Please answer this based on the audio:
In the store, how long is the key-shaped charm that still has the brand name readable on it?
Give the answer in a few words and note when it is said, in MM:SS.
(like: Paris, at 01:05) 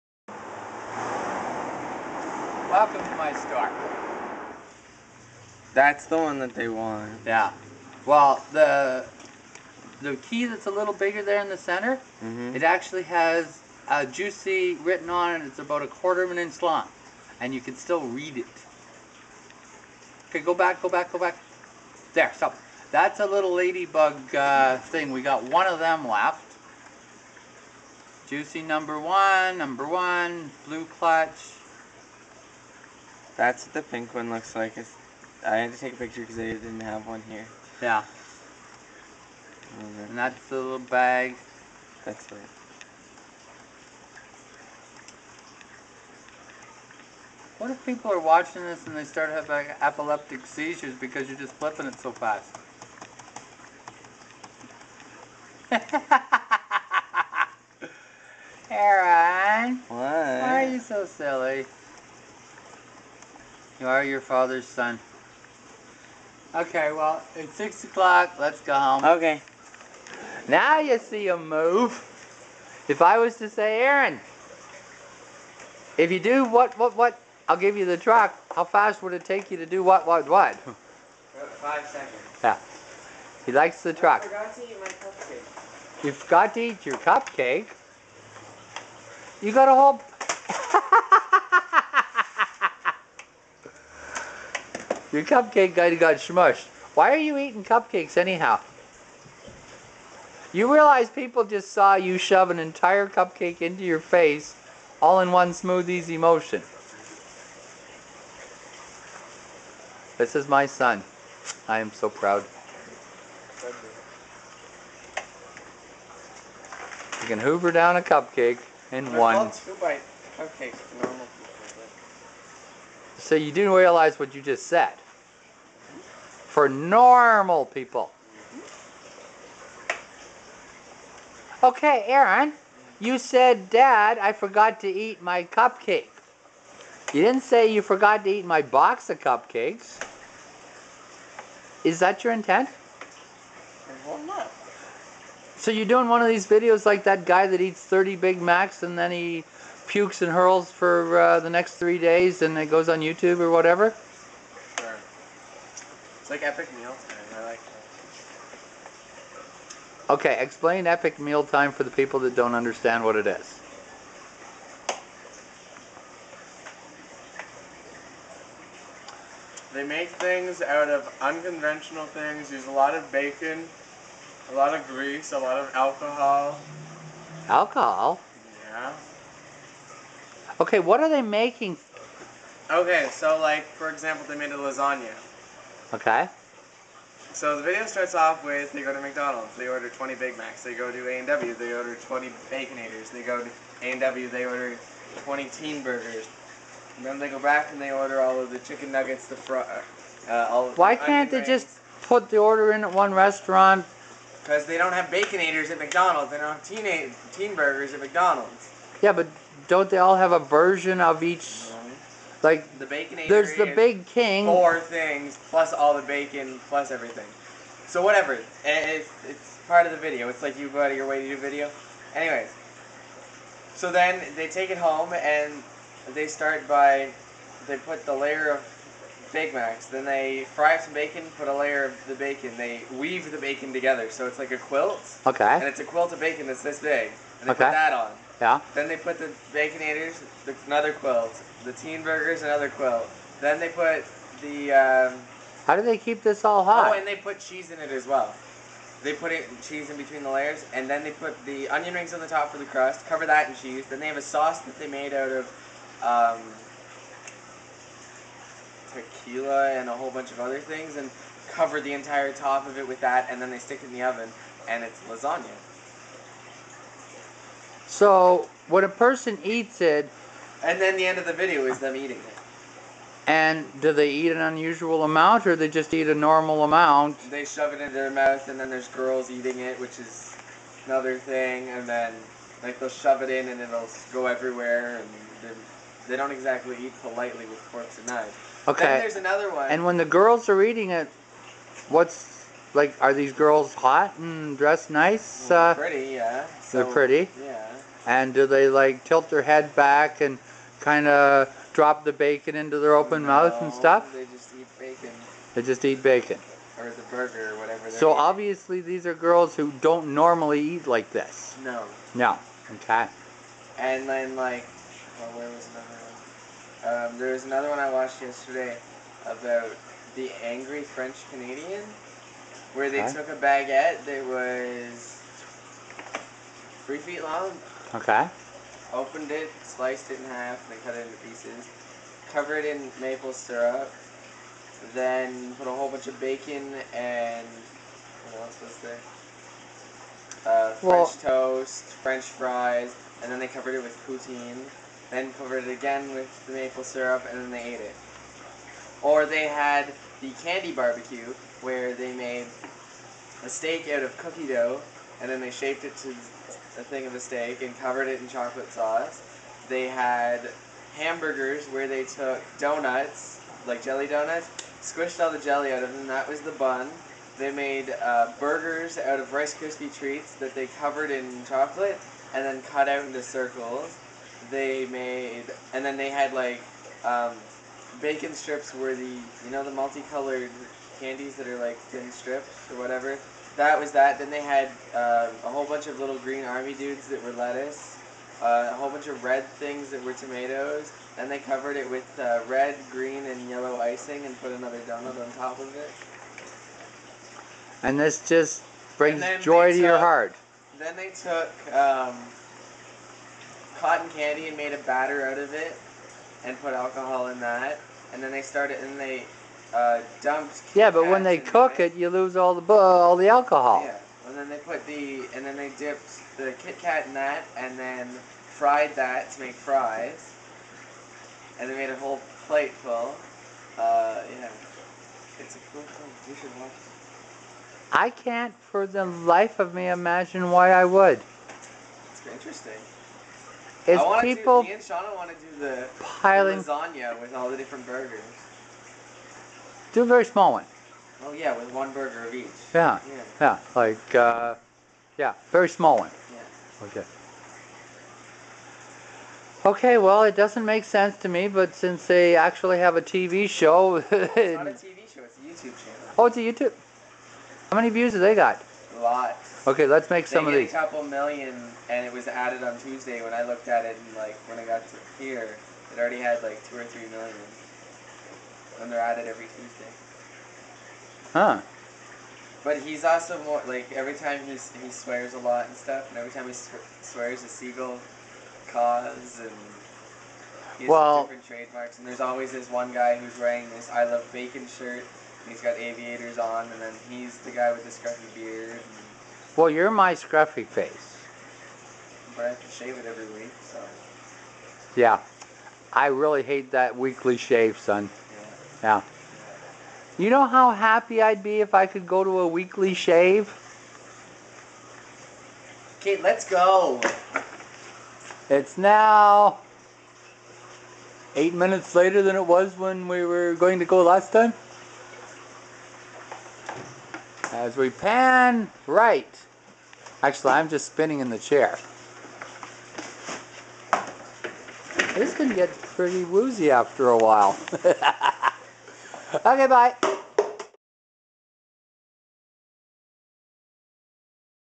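a quarter of an inch, at 00:15.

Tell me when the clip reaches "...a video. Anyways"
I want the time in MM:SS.
03:41.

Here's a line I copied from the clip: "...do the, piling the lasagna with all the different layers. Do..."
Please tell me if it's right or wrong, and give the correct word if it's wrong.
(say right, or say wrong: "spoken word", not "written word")
wrong: "burgers", not "layers".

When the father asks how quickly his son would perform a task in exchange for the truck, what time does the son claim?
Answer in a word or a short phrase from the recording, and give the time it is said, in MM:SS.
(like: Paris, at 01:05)
5 seconds, at 01:20.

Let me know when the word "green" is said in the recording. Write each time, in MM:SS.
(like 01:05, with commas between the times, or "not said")
06:26, 06:32.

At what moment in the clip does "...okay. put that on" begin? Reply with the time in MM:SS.
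03:57.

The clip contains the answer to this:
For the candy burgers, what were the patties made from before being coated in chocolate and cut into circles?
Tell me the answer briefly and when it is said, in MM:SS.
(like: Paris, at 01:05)
Rice Krispie treats, at 06:09.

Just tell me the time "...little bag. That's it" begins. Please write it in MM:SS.
00:40.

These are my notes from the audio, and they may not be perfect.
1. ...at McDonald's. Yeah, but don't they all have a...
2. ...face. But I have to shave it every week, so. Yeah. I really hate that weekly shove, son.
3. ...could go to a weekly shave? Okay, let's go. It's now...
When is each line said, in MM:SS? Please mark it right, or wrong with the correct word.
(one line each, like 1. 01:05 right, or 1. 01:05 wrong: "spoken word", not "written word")
1. 03:27 right
2. 08:10 wrong: "shave", not "shove"
3. 08:21 right.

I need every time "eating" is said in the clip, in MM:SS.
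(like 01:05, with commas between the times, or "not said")
01:37, 04:31, 04:39, 04:50, 05:08.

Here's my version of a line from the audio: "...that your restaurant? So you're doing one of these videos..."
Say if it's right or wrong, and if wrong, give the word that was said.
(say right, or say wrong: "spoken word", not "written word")
wrong: "intent", not "restaurant".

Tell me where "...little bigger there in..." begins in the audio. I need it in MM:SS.
00:10.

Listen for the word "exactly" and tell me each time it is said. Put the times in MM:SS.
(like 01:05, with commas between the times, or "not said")
04:46.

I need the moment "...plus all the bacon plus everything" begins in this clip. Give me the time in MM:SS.
03:35.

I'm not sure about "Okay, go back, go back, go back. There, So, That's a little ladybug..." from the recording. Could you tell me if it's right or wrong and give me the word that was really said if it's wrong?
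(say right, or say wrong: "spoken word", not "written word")
right.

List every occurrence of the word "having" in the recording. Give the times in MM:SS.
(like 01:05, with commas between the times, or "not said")
00:49.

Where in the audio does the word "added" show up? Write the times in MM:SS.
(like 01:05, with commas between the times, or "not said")
07:42, 07:48.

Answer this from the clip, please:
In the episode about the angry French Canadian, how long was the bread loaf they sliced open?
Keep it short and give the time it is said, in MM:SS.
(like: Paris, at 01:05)
3 feet, at 05:26.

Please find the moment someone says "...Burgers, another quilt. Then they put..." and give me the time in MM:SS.
04:02.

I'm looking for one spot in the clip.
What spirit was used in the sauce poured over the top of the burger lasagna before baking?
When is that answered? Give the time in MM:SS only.
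04:18.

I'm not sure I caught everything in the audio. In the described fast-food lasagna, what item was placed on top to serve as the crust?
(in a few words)
onion rings.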